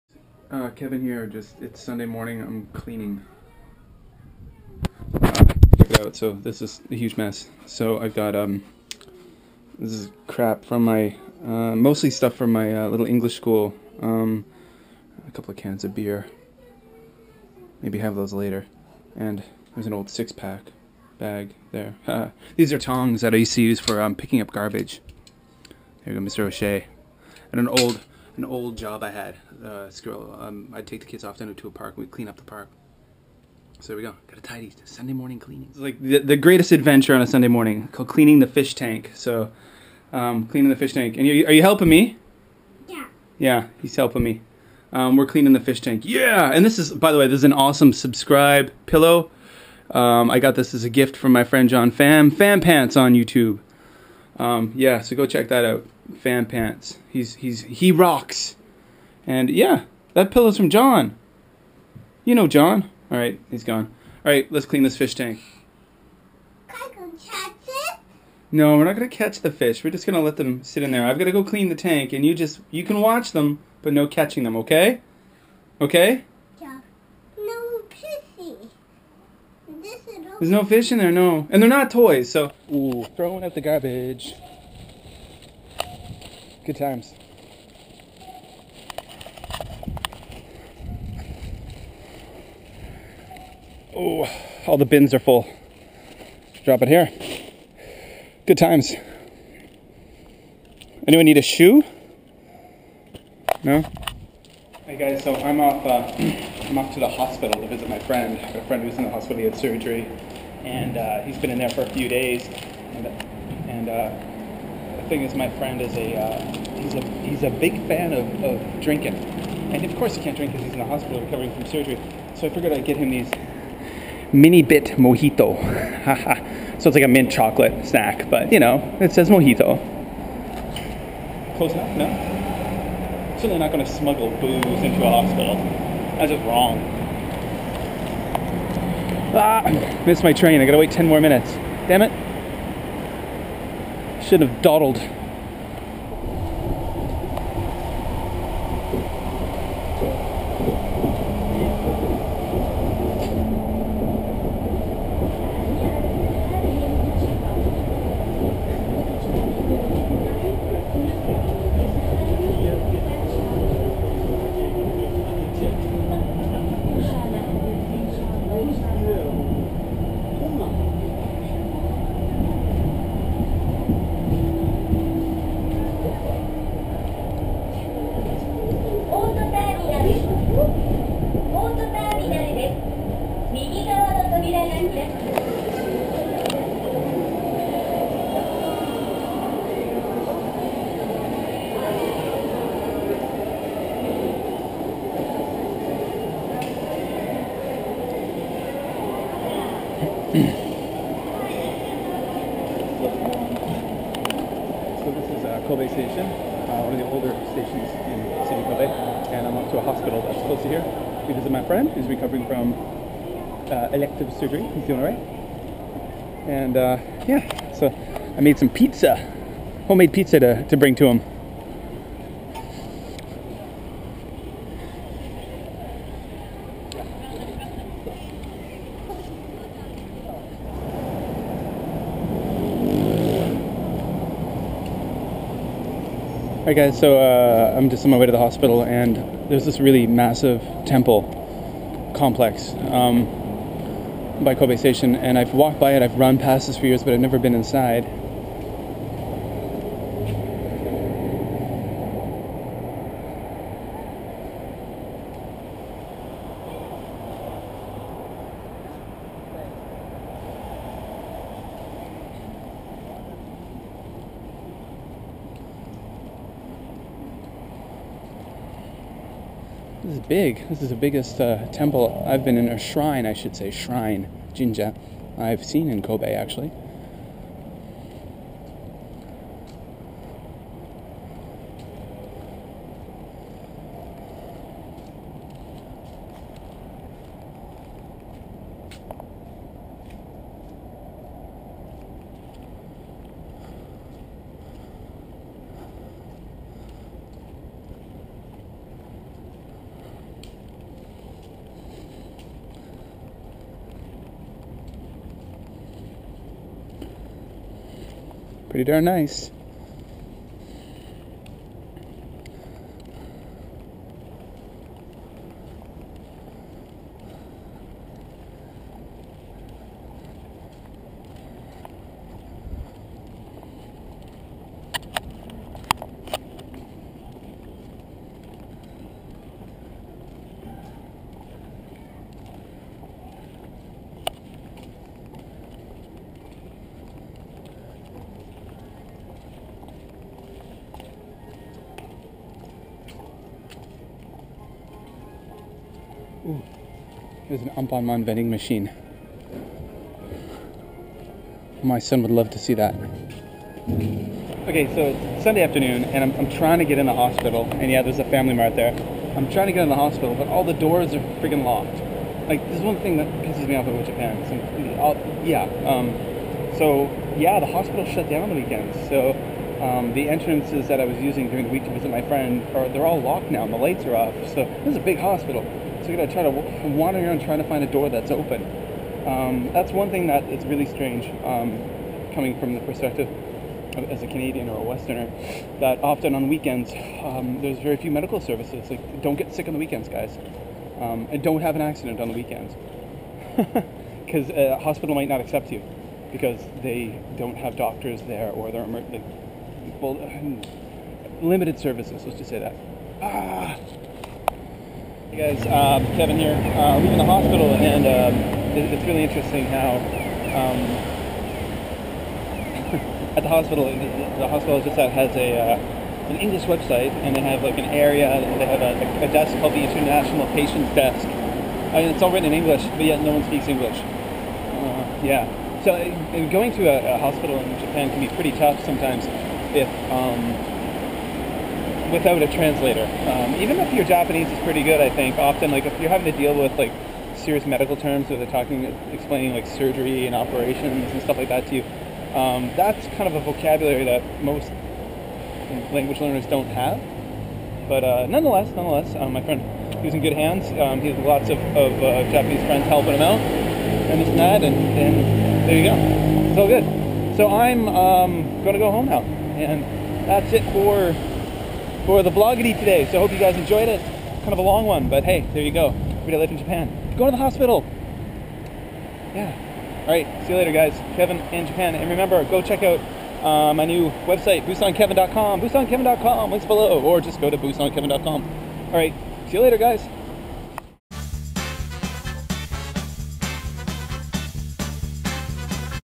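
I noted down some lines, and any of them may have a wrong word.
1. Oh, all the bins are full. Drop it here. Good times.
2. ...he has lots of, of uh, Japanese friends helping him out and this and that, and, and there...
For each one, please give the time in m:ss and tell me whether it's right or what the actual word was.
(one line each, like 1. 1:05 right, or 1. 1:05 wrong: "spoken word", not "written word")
1. 1:33 right
2. 7:31 right.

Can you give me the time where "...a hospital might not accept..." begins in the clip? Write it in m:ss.
6:34.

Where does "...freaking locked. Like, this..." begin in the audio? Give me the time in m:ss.
6:01.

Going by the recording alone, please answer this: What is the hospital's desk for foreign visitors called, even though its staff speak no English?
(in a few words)
International Patient Desk.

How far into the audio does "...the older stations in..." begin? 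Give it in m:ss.
3:26.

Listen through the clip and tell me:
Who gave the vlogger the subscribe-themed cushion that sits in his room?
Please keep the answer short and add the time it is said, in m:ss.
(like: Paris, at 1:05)
John Pham, at 0:51.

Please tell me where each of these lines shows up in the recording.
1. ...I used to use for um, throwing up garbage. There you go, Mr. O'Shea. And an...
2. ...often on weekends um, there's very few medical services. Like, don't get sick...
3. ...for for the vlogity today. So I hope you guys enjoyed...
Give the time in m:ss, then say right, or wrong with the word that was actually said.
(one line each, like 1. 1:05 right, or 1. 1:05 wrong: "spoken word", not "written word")
1. 0:23 wrong: "picking", not "throwing"
2. 6:26 right
3. 7:40 right.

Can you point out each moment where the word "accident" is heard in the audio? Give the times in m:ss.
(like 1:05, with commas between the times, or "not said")
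6:31.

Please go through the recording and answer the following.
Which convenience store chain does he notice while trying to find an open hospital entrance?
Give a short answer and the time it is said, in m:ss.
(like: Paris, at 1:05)
Family Mart, at 5:58.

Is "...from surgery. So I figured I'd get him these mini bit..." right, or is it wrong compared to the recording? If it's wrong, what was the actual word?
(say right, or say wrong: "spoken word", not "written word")
right.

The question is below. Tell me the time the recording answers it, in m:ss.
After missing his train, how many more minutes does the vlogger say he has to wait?
2:20.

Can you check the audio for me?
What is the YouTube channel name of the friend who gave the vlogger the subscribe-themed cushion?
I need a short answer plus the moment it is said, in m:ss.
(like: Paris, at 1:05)
PhamPants, at 0:56.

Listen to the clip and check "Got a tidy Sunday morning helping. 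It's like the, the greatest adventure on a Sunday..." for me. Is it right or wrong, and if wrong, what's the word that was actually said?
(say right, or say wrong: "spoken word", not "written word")
wrong: "cleaning", not "helping".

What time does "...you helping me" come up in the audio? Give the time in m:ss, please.
0:41.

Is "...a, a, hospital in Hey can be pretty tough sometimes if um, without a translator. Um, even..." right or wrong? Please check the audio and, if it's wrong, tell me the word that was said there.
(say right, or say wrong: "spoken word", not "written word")
wrong: "Japan", not "Hey".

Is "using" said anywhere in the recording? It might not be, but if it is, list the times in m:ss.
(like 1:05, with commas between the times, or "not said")
6:11.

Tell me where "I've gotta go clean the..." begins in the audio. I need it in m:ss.
1:11.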